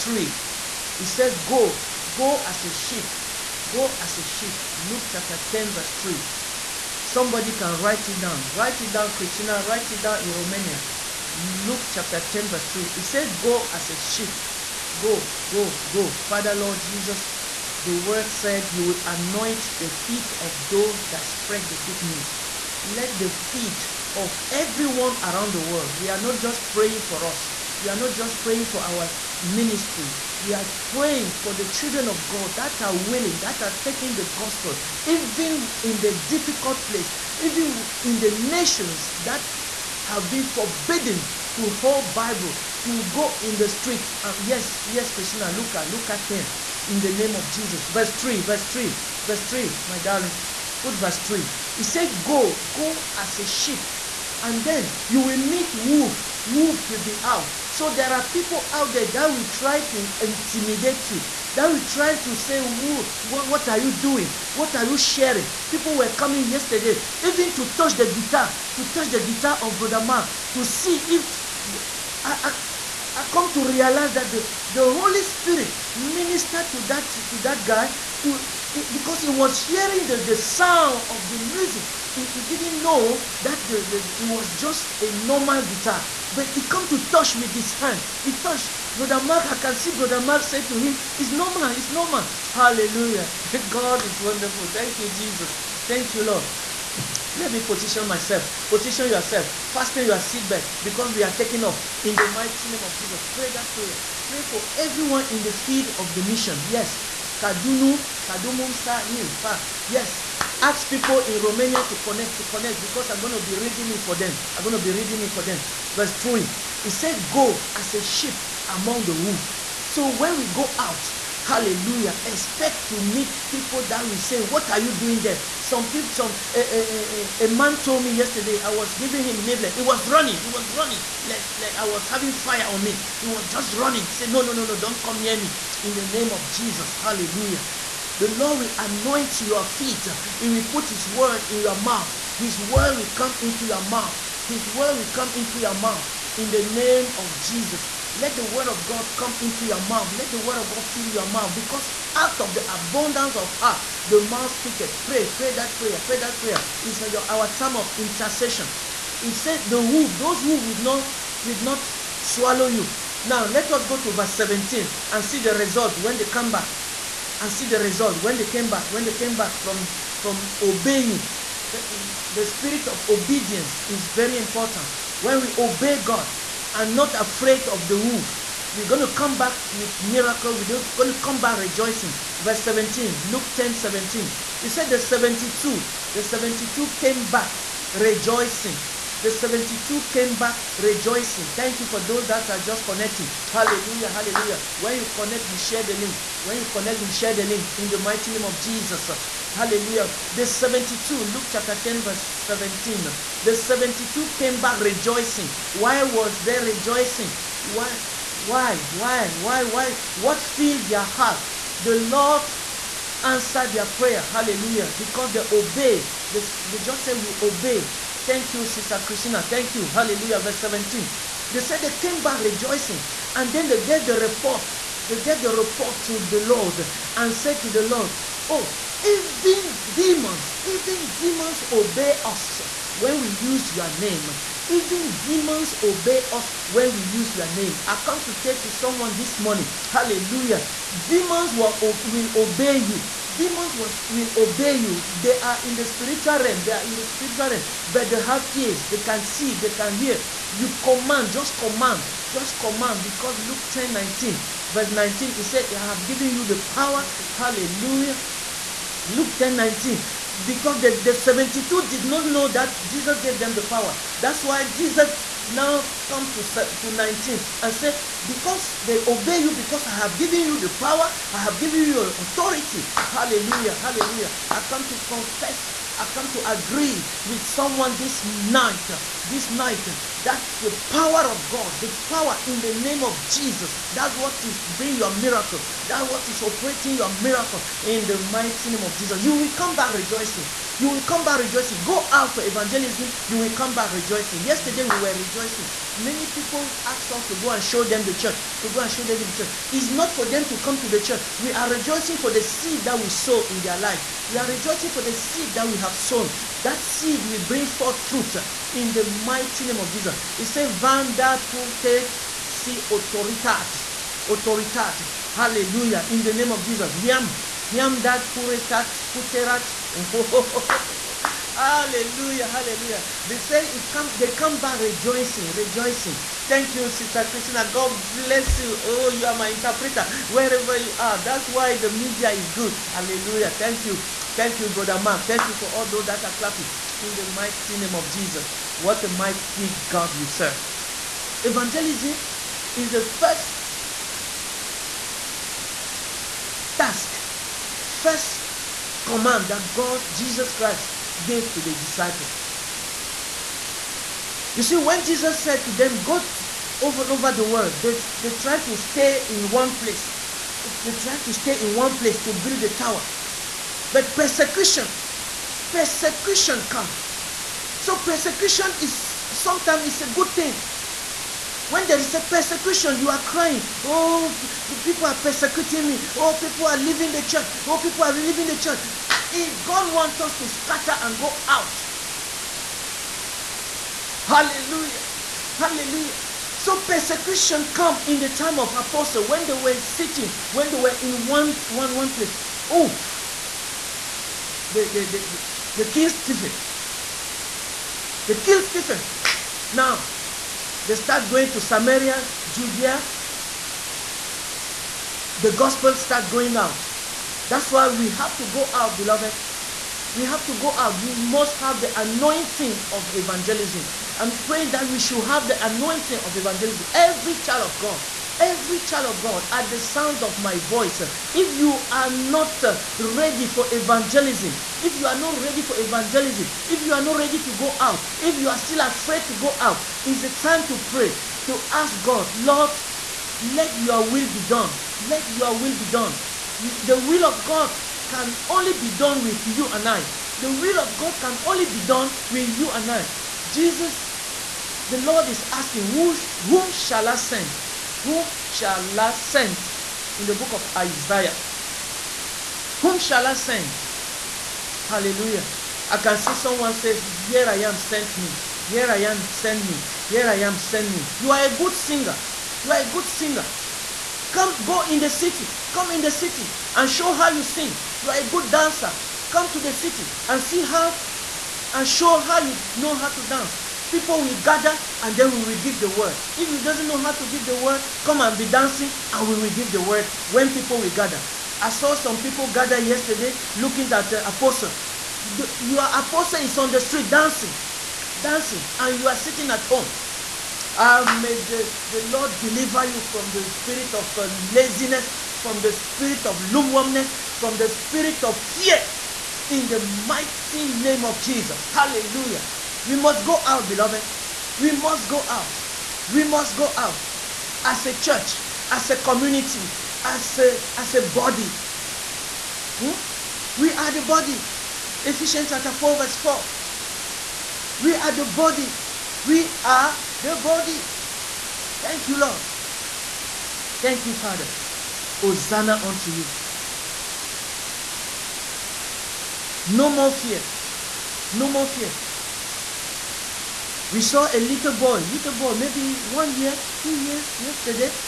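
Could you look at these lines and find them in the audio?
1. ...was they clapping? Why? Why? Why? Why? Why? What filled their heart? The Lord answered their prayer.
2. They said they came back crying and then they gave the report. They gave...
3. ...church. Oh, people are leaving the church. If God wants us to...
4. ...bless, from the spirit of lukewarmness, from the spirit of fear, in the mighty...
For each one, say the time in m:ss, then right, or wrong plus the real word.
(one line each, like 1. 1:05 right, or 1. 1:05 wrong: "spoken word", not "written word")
1. 3:26 wrong: "rejoicing", not "clapping"
2. 3:41 wrong: "rejoicing", not "crying"
3. 6:17 right
4. 8:14 wrong: "laziness", not "bless".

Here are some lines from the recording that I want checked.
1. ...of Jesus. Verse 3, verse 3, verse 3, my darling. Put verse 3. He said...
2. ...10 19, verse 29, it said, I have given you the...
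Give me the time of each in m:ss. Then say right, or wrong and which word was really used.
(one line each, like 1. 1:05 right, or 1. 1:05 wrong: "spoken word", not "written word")
1. 0:47 right
2. 4:13 wrong: "19", not "29".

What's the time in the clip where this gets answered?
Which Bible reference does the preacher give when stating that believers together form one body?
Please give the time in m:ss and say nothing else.
8:35.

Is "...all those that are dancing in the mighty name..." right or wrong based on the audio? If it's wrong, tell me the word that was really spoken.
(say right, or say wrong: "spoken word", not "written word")
wrong: "clapping", not "dancing".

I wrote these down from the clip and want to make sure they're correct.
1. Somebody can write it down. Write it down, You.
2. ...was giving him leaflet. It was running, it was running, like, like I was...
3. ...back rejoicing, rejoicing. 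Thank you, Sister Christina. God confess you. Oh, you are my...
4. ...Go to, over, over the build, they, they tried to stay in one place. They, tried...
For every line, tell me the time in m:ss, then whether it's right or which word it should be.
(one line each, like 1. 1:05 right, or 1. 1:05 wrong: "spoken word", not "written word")
1. 0:07 wrong: "Christina", not "You"
2. 2:08 right
3. 5:24 wrong: "bless", not "confess"
4. 5:56 wrong: "world", not "build".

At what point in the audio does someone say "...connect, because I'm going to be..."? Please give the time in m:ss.
1:52.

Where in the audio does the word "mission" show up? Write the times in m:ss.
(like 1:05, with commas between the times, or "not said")
1:46.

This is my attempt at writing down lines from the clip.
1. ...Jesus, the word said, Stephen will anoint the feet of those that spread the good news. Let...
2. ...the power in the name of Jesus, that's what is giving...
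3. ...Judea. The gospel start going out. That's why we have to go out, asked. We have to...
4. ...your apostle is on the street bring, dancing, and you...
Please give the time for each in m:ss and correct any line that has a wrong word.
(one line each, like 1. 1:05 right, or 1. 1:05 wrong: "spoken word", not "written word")
1. 0:16 wrong: "You", not "Stephen"
2. 4:41 wrong: "bring", not "giving"
3. 6:42 wrong: "beloved", not "asked"
4. 8:05 wrong: "dancing", not "bring".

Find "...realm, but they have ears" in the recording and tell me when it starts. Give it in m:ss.
4:07.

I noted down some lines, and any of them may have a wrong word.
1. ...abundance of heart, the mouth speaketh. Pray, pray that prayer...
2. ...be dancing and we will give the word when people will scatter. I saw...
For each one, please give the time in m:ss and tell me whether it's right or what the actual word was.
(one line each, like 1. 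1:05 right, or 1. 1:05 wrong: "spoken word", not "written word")
1. 2:32 right
2. 7:58 wrong: "gather", not "scatter".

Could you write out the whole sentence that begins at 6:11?
When there is a persecution, you are crying.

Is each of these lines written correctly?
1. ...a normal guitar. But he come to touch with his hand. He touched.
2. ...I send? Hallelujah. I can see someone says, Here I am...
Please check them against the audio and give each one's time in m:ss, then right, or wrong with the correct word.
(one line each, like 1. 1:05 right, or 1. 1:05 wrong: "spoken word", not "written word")
1. 1:25 right
2. 7:33 right.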